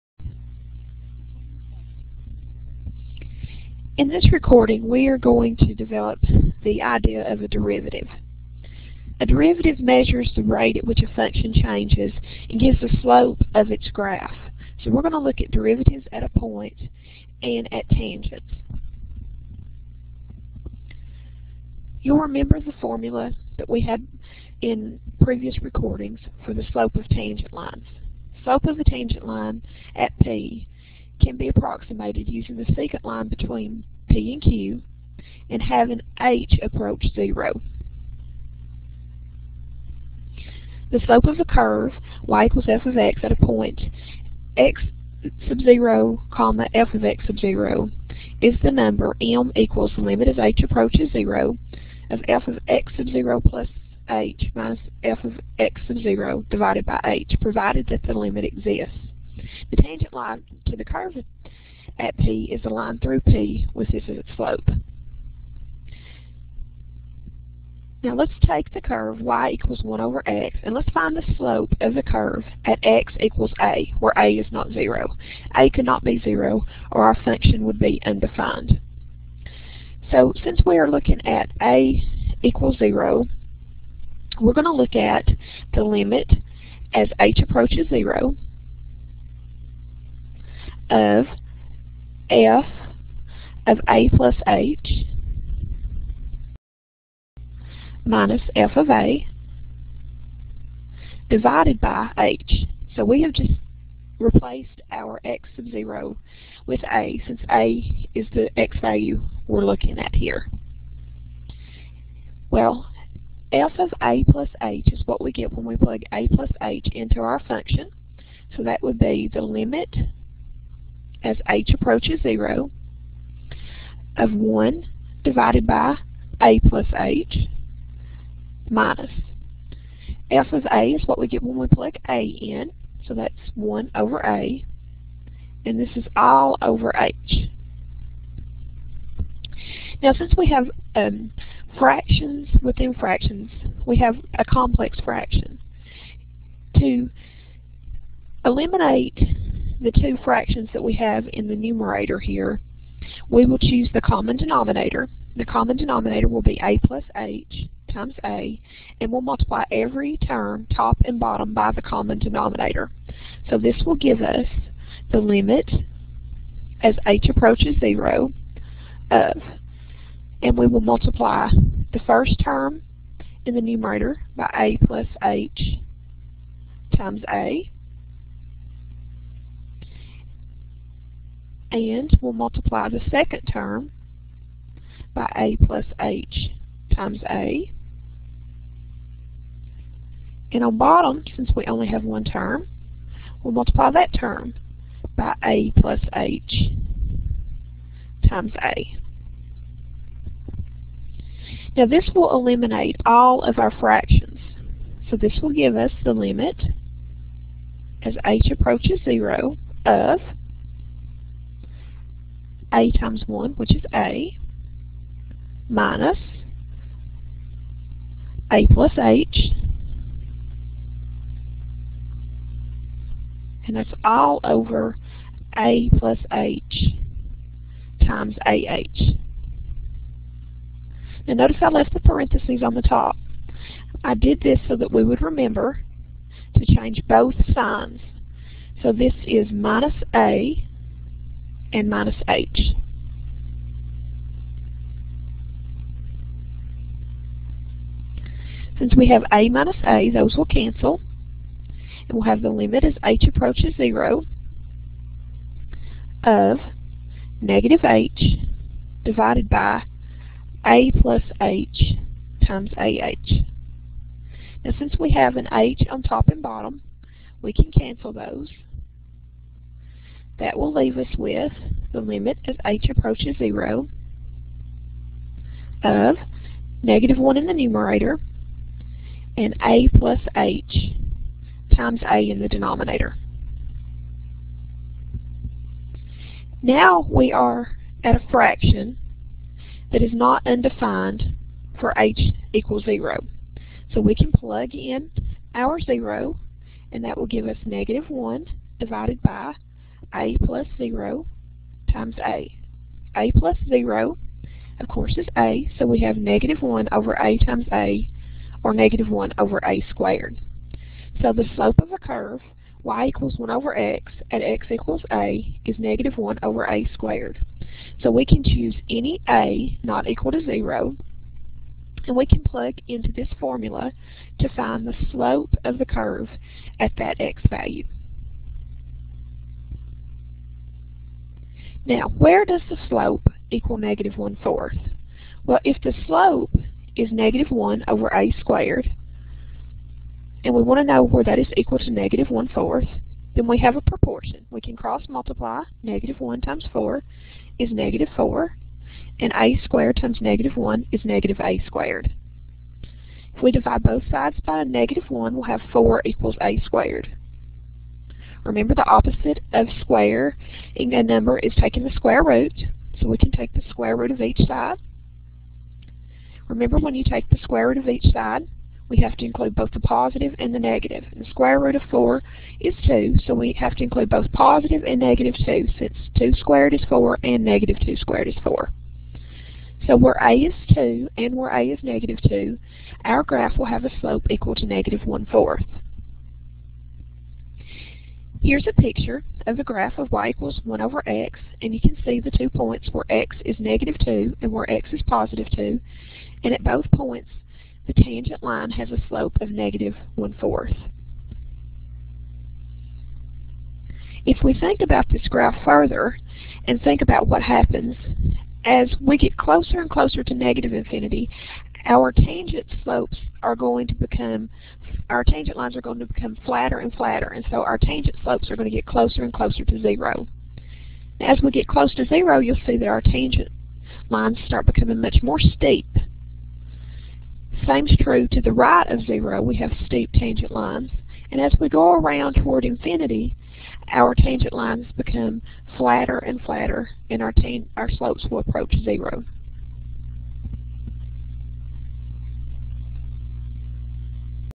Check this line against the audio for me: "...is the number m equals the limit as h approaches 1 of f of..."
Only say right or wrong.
wrong.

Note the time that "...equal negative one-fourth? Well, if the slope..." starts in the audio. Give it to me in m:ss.
5:33.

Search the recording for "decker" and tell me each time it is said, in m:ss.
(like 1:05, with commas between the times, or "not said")
not said.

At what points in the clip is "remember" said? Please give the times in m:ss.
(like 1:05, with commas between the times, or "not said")
0:22, 3:55, 5:58, 6:06.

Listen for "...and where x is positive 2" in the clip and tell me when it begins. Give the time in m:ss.
6:34.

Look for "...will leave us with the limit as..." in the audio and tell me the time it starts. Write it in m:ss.
4:30.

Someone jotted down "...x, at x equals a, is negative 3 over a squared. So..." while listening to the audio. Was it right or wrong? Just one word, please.
wrong.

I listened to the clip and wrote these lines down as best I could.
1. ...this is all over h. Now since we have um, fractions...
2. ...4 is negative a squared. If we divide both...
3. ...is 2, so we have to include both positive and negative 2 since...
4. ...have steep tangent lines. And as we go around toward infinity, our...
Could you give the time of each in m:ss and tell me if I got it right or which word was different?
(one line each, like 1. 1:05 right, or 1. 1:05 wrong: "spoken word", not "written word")
1. 2:15 right
2. 5:50 wrong: "1", not "4"
3. 6:12 right
4. 7:09 right.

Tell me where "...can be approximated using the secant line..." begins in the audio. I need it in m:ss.
0:31.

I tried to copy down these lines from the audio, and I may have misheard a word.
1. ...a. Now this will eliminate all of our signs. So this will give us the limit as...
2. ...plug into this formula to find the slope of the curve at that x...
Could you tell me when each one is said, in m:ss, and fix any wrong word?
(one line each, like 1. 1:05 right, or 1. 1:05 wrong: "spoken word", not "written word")
1. 3:18 wrong: "fractions", not "signs"
2. 5:22 right.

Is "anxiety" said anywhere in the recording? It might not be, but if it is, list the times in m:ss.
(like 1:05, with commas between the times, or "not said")
not said.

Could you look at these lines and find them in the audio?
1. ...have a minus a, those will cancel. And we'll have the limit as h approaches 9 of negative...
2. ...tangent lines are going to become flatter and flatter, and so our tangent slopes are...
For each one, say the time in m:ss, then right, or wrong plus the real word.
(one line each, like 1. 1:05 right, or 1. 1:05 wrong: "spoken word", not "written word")
1. 4:09 wrong: "0", not "9"
2. 6:55 right.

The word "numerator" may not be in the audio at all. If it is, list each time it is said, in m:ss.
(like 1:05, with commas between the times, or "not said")
2:31, 2:53, 4:37.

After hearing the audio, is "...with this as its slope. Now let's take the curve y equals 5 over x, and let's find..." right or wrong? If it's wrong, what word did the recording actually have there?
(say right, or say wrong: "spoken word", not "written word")
wrong: "1", not "5".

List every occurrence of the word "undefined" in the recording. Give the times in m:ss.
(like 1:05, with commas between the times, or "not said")
1:18, 4:50.